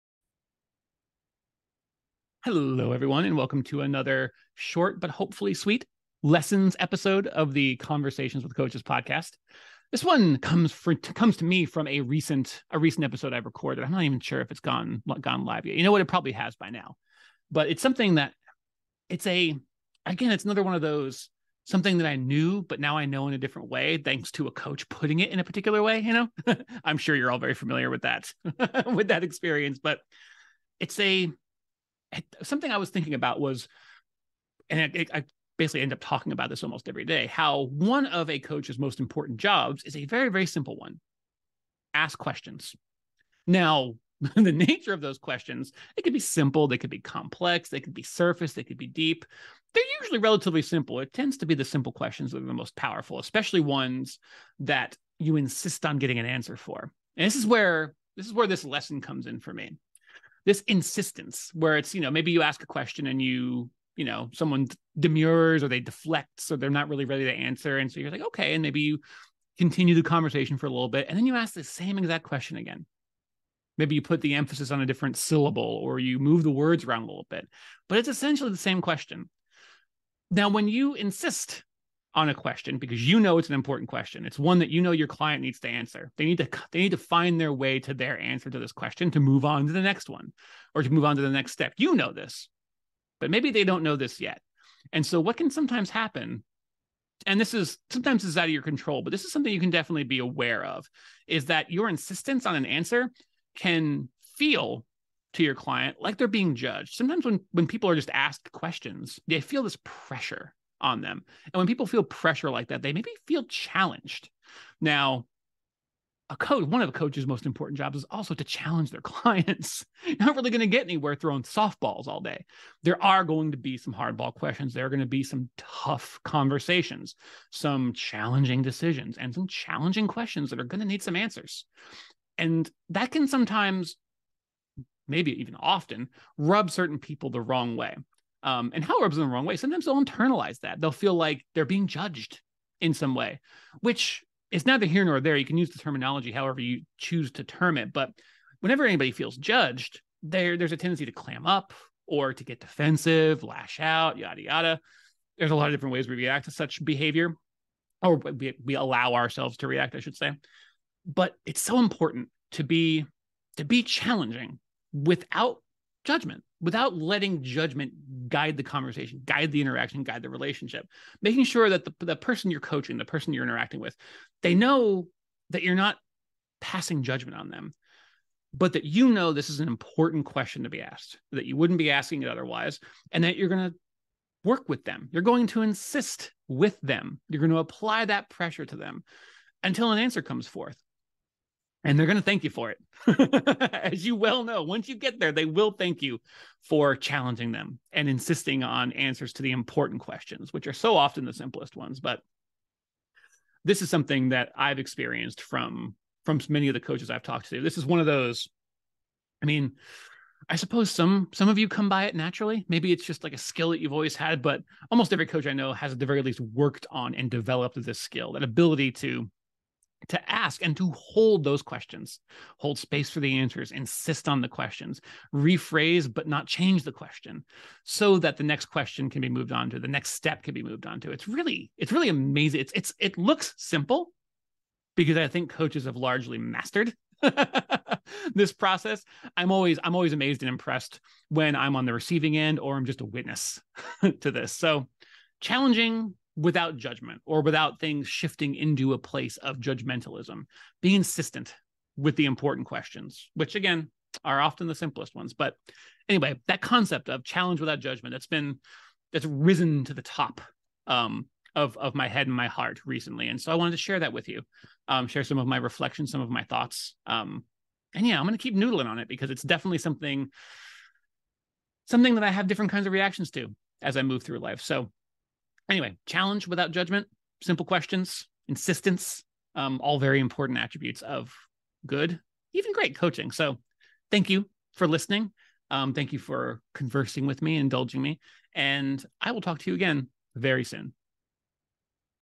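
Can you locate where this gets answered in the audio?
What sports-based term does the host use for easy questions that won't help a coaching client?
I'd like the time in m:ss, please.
2:01.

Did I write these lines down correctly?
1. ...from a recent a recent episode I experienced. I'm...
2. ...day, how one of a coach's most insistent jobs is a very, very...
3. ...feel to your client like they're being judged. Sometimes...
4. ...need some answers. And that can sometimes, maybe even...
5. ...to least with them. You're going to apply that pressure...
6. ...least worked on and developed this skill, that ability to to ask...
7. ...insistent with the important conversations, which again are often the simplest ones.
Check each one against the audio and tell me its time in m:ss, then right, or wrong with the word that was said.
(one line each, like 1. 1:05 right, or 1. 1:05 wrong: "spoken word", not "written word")
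1. 0:11 wrong: "recorded", not "experienced"
2. 0:37 wrong: "important", not "insistent"
3. 1:44 right
4. 2:10 right
5. 3:05 wrong: "insist", not "least"
6. 3:36 right
7. 4:10 wrong: "questions", not "conversations".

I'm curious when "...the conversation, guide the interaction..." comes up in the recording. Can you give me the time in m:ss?
2:48.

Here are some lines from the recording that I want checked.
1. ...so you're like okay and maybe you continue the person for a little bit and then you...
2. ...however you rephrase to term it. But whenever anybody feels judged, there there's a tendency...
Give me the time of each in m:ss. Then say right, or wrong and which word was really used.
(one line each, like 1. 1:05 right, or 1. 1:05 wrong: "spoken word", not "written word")
1. 1:07 wrong: "conversation", not "person"
2. 2:26 wrong: "choose", not "rephrase".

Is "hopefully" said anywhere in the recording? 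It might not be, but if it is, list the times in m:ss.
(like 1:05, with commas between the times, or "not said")
0:05.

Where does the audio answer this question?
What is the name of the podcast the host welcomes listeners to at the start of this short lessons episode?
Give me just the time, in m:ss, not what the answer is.
0:07.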